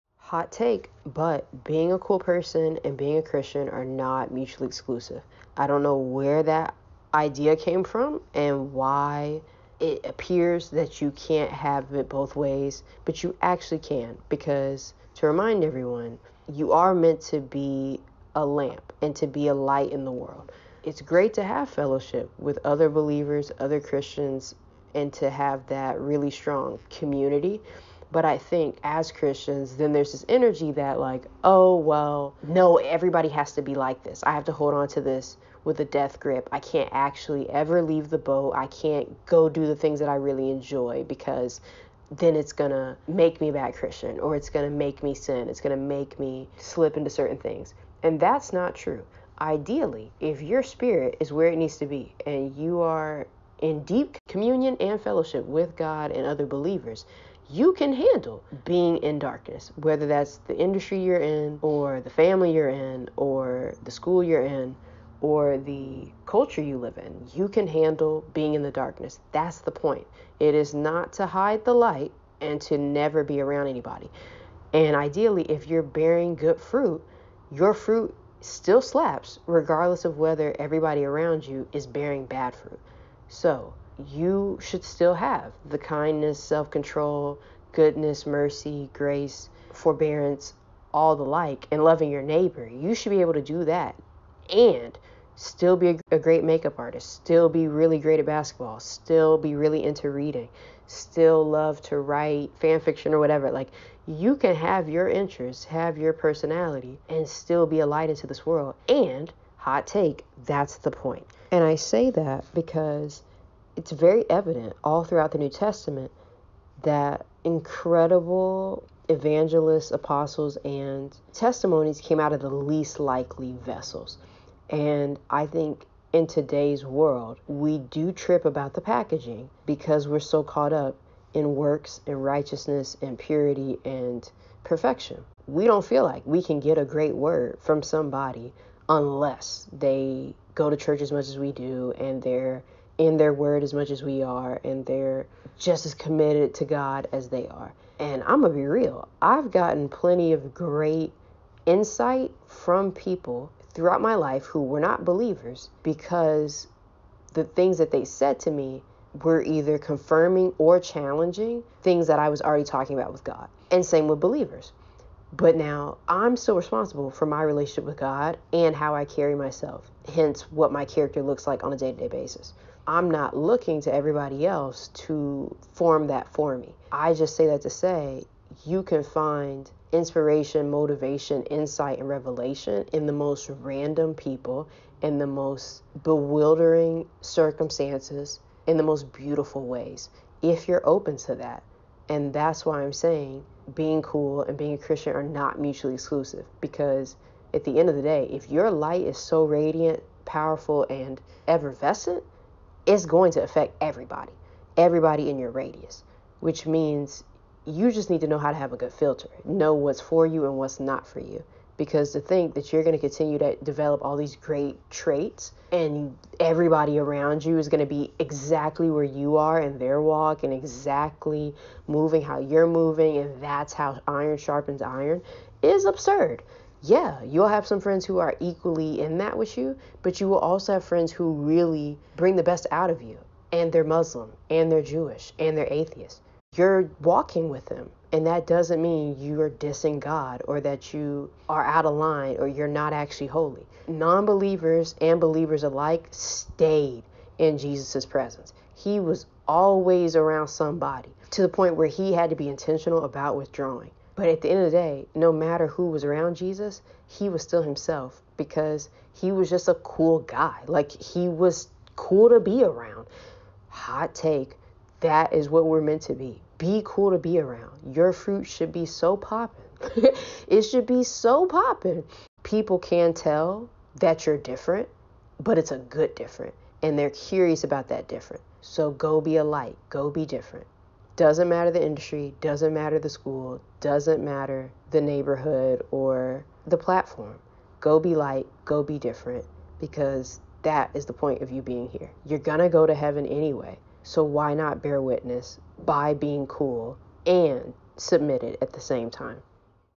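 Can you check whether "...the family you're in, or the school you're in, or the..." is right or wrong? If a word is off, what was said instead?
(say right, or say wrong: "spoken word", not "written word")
right.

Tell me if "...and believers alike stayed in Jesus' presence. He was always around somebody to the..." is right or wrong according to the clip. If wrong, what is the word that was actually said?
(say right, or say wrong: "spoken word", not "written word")
right.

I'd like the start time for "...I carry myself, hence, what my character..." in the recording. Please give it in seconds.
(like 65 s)
168 s.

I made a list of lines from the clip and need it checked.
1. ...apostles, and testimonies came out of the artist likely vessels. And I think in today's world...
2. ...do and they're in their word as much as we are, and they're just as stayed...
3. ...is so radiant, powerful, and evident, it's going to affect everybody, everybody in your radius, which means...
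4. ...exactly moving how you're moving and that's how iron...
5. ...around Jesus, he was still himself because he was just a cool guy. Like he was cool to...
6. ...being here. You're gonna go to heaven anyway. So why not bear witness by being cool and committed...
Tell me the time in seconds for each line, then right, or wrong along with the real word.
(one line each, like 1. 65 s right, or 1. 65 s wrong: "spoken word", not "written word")
1. 119 s wrong: "least", not "artist"
2. 141 s wrong: "committed", not "stayed"
3. 199 s wrong: "effervescent", not "evident"
4. 220 s right
5. 256 s right
6. 291 s wrong: "submitted", not "committed".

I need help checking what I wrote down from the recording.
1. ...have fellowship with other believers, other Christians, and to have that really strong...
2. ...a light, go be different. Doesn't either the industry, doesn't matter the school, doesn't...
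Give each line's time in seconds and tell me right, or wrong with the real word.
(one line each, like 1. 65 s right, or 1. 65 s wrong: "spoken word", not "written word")
1. 21 s right
2. 279 s wrong: "matter", not "either".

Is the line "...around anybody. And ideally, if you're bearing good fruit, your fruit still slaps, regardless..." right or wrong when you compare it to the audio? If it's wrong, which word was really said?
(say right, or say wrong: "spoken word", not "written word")
right.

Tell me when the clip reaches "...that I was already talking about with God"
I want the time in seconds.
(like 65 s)
162 s.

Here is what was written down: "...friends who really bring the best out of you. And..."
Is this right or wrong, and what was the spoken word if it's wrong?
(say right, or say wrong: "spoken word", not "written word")
right.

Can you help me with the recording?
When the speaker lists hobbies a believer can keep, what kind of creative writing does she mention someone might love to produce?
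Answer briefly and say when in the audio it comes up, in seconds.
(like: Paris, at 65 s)
fan fiction, at 102 s.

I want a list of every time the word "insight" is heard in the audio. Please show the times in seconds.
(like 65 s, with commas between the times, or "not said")
151 s, 181 s.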